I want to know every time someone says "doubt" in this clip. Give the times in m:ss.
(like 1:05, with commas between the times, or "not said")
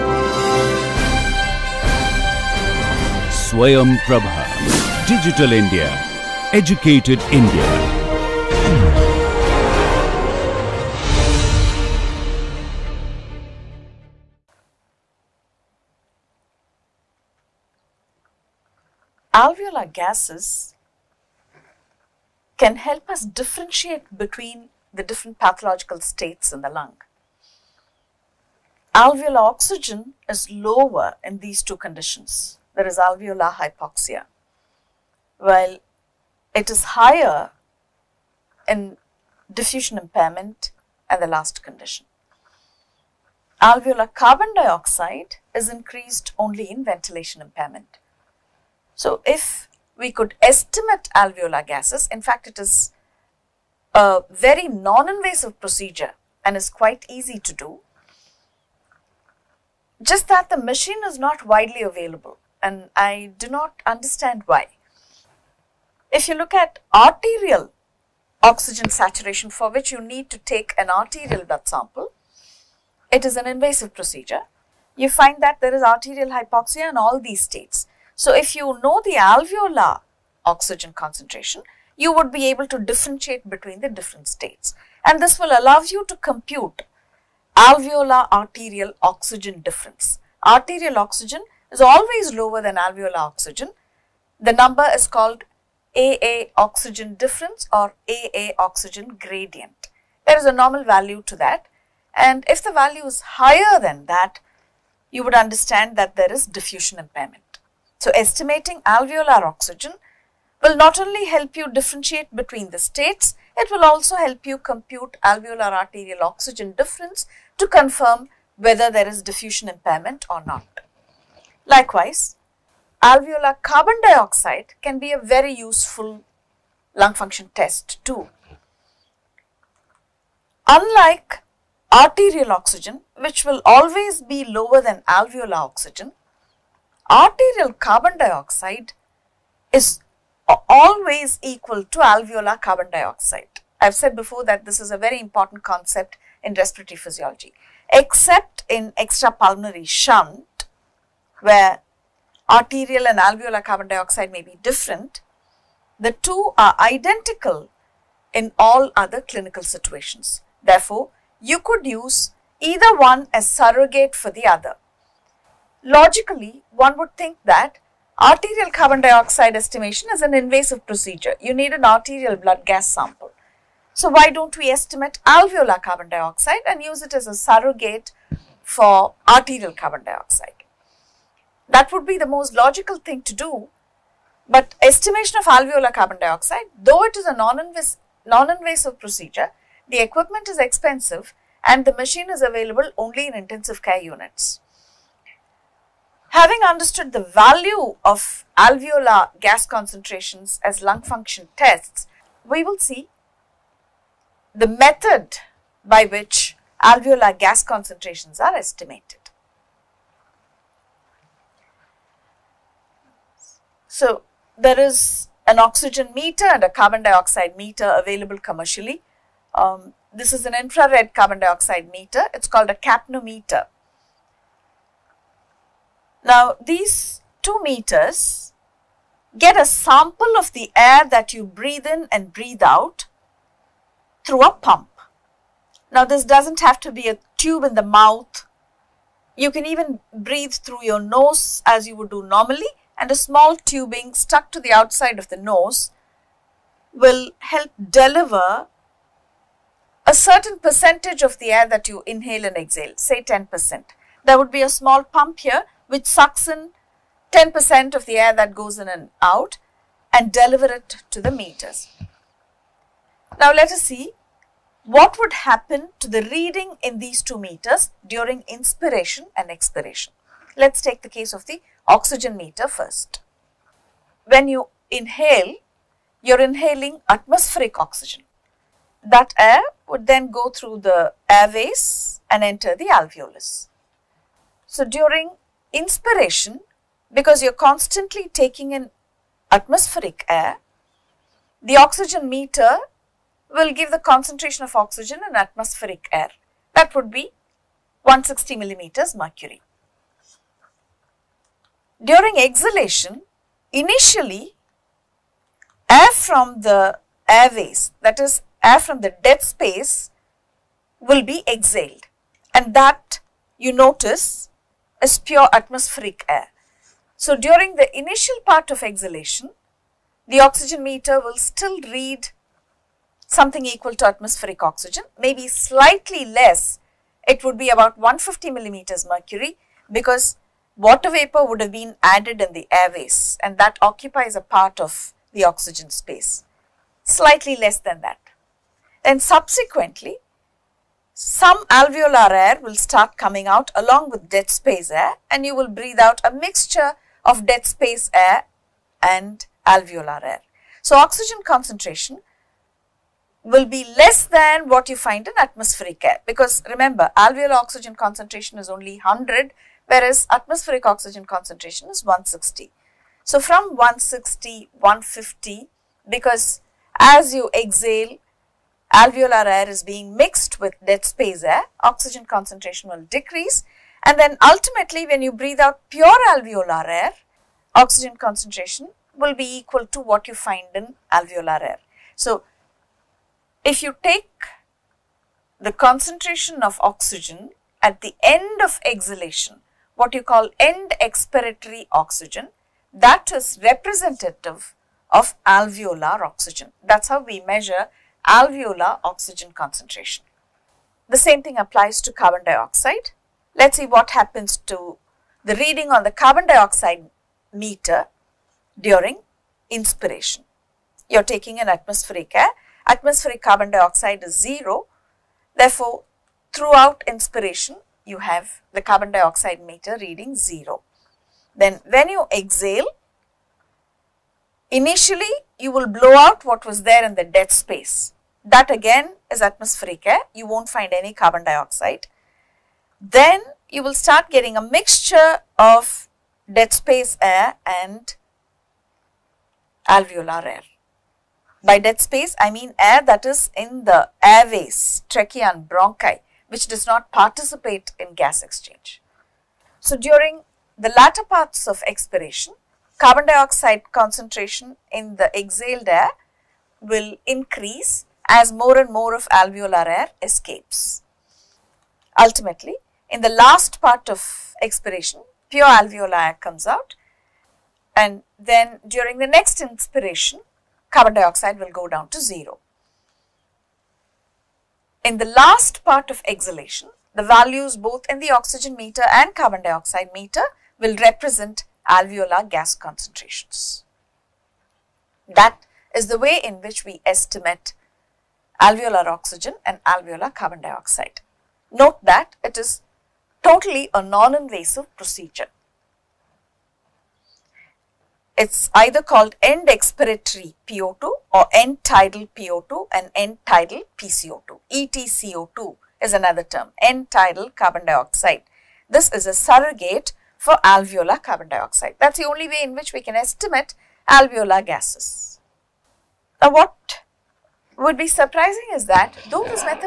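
not said.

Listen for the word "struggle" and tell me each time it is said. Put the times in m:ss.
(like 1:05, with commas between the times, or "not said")
not said.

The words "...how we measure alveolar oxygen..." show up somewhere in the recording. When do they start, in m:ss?
6:37.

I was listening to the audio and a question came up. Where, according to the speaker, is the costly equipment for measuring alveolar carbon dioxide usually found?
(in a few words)
Intensive care units.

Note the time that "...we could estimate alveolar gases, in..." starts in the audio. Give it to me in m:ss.
0:49.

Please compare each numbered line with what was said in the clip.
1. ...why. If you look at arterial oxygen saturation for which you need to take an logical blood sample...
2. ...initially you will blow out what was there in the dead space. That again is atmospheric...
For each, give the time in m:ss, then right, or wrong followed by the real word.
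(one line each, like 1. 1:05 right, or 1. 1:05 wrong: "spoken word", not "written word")
1. 1:04 wrong: "arterial", not "logical"
2. 7:04 right.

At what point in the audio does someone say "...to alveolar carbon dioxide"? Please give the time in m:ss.
2:21.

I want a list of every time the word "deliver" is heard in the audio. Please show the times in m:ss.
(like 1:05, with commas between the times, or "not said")
4:07, 4:20.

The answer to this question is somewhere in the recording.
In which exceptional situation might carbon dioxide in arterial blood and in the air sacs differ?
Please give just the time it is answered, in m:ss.
2:28.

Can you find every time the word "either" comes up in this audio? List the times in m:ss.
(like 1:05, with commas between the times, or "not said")
2:42, 8:18.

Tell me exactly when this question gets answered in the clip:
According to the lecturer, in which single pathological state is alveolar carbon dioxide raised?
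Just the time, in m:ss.
0:46.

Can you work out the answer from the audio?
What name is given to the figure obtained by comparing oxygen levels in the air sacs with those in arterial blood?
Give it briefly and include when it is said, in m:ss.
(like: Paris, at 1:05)
AA oxygen difference, at 1:35.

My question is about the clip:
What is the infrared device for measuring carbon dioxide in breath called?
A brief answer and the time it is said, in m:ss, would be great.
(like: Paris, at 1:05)
Capnometer, at 3:42.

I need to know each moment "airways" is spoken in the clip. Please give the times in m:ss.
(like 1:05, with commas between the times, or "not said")
4:41, 5:07, 5:32, 7:24.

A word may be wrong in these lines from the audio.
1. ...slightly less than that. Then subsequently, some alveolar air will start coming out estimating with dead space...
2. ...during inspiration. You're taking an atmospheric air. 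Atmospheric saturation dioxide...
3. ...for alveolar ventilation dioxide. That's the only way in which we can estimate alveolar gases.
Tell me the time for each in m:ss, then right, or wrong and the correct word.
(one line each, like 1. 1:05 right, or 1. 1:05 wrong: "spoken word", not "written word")
1. 5:37 wrong: "along", not "estimating"
2. 6:48 wrong: "carbon", not "saturation"
3. 8:30 wrong: "carbon", not "ventilation".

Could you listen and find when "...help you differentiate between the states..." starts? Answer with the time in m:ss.
1:51.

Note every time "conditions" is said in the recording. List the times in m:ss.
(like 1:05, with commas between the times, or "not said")
0:31, 0:41.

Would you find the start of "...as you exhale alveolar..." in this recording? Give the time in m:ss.
6:06.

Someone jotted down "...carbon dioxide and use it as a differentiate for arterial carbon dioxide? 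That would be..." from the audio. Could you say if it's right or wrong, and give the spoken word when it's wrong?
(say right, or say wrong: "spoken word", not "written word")
wrong: "surrogate", not "differentiate".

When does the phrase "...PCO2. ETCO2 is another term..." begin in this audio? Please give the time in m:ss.
8:23.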